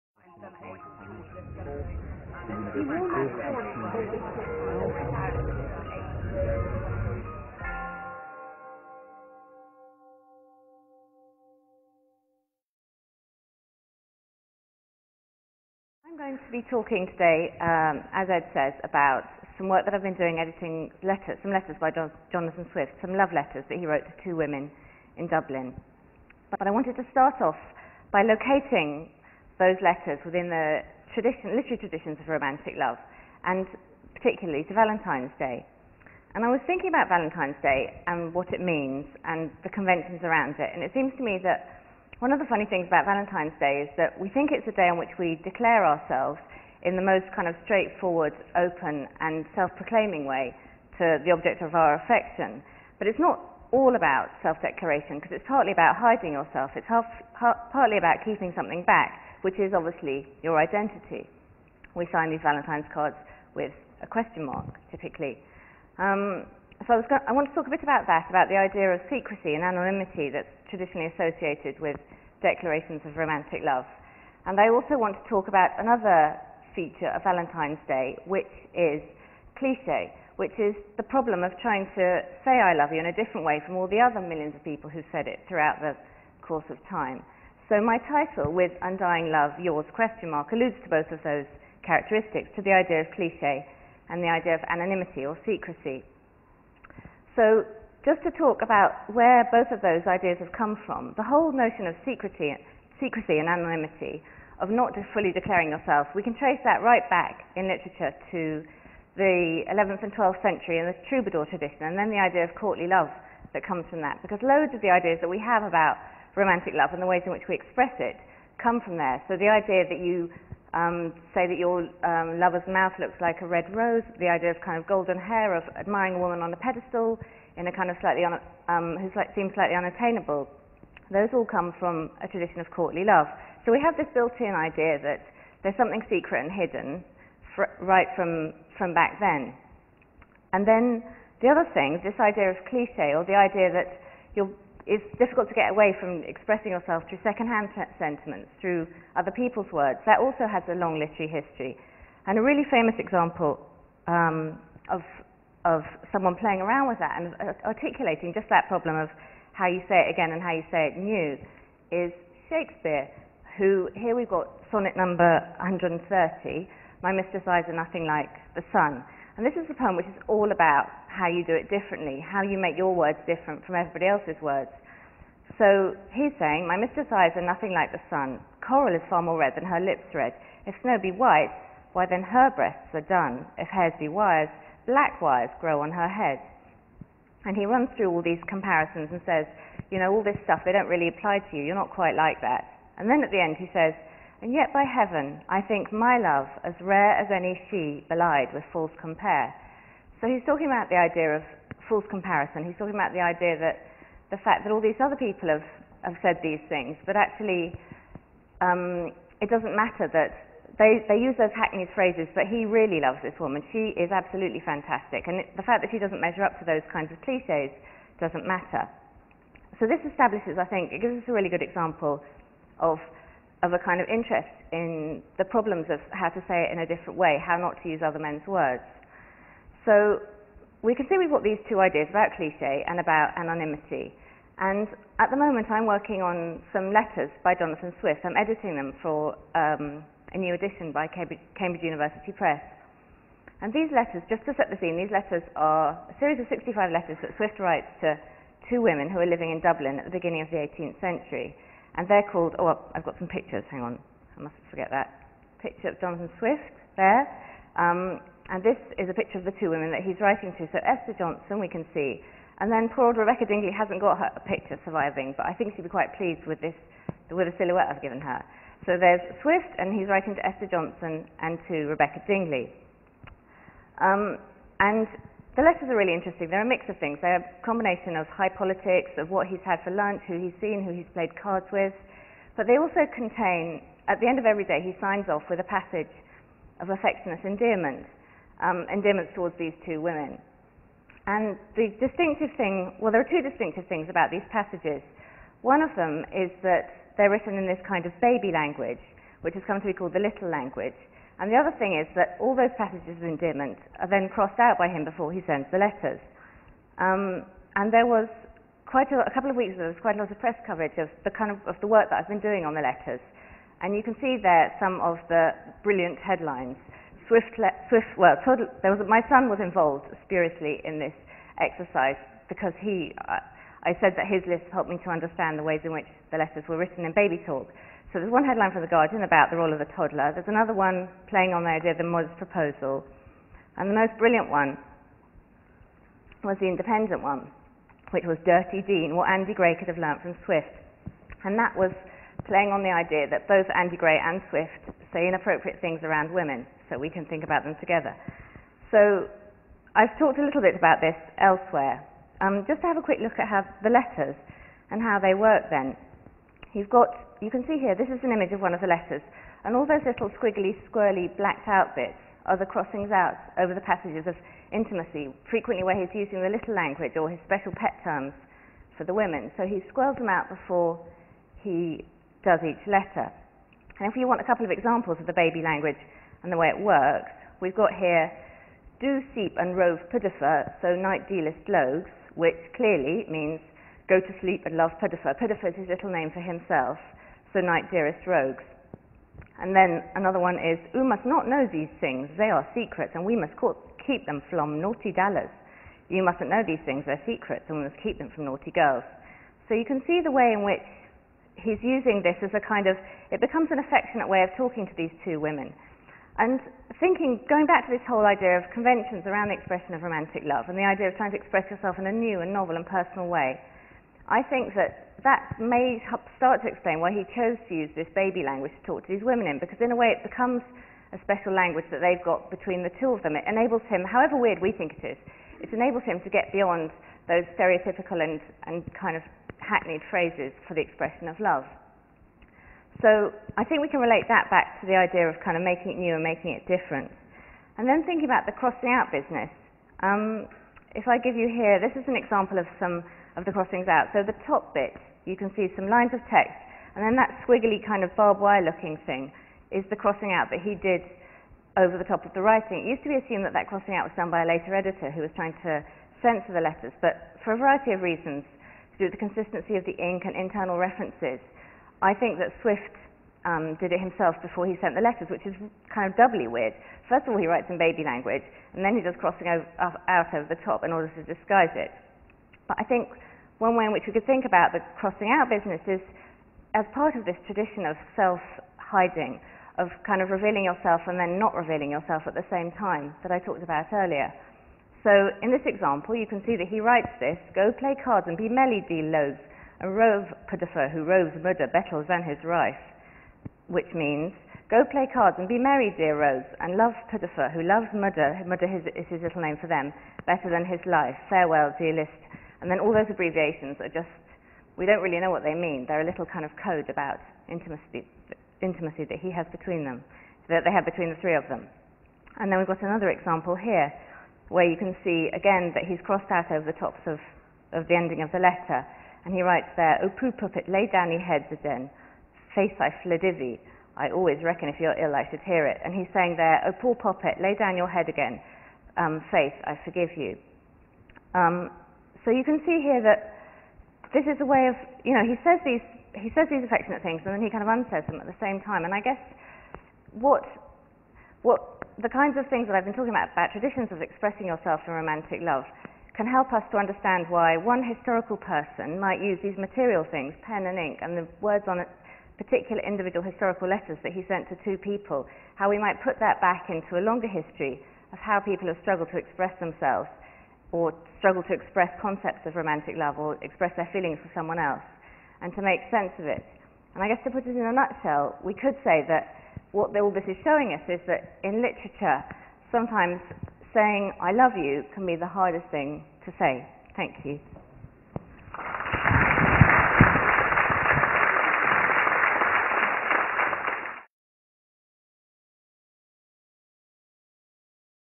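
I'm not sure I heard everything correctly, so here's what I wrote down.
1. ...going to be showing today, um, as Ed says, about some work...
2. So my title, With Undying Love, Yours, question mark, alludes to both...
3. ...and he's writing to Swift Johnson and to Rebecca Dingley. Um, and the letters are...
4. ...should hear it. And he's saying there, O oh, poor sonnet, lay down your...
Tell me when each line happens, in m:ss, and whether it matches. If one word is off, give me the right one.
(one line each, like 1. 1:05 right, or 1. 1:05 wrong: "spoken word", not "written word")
1. 0:16 wrong: "talking", not "showing"
2. 1:27 right
3. 4:29 wrong: "Esther", not "Swift"
4. 8:45 wrong: "poppet", not "sonnet".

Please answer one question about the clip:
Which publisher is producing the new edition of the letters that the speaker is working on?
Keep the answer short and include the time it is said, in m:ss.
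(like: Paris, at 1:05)
Cambridge University Press, at 4:01.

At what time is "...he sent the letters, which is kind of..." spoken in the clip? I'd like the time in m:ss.
7:44.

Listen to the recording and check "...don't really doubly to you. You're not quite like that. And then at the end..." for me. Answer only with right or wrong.
wrong.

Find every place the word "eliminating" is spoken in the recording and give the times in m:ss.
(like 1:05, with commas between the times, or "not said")
not said.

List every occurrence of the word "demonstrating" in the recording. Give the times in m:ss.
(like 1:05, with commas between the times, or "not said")
not said.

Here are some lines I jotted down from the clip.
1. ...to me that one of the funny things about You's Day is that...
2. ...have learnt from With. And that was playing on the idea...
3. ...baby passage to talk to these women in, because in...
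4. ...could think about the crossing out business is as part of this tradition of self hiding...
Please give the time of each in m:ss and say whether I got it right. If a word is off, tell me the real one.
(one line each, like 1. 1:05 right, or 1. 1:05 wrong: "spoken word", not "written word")
1. 0:41 wrong: "Valentine", not "You"
2. 5:39 wrong: "Swift", not "With"
3. 6:58 wrong: "language", not "passage"
4. 7:54 right.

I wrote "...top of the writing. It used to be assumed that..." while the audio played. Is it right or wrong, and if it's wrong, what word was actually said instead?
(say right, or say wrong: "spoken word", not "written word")
right.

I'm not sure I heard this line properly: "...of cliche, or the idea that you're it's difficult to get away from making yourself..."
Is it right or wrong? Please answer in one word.
wrong.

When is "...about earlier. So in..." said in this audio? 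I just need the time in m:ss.
8:03.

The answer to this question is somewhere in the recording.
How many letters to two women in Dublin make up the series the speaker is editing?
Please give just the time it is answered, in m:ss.
4:06.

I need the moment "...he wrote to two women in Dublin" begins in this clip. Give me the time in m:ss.
0:23.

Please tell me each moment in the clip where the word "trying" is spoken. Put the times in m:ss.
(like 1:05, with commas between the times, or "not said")
1:21, 6:51, 7:35.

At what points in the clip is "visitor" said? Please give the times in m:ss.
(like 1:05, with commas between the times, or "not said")
not said.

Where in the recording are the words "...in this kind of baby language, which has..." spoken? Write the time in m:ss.
4:57.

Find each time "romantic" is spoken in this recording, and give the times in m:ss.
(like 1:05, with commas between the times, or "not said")
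0:32, 1:13, 1:56, 6:50, 9:04, 9:22.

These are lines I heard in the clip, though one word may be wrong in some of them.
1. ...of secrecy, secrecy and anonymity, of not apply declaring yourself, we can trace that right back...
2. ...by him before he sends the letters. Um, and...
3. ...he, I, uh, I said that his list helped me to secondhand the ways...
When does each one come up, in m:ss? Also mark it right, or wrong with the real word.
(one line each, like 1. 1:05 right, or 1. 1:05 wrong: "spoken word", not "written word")
1. 1:41 wrong: "fully", not "apply"
2. 5:04 right
3. 5:22 wrong: "understand", not "secondhand".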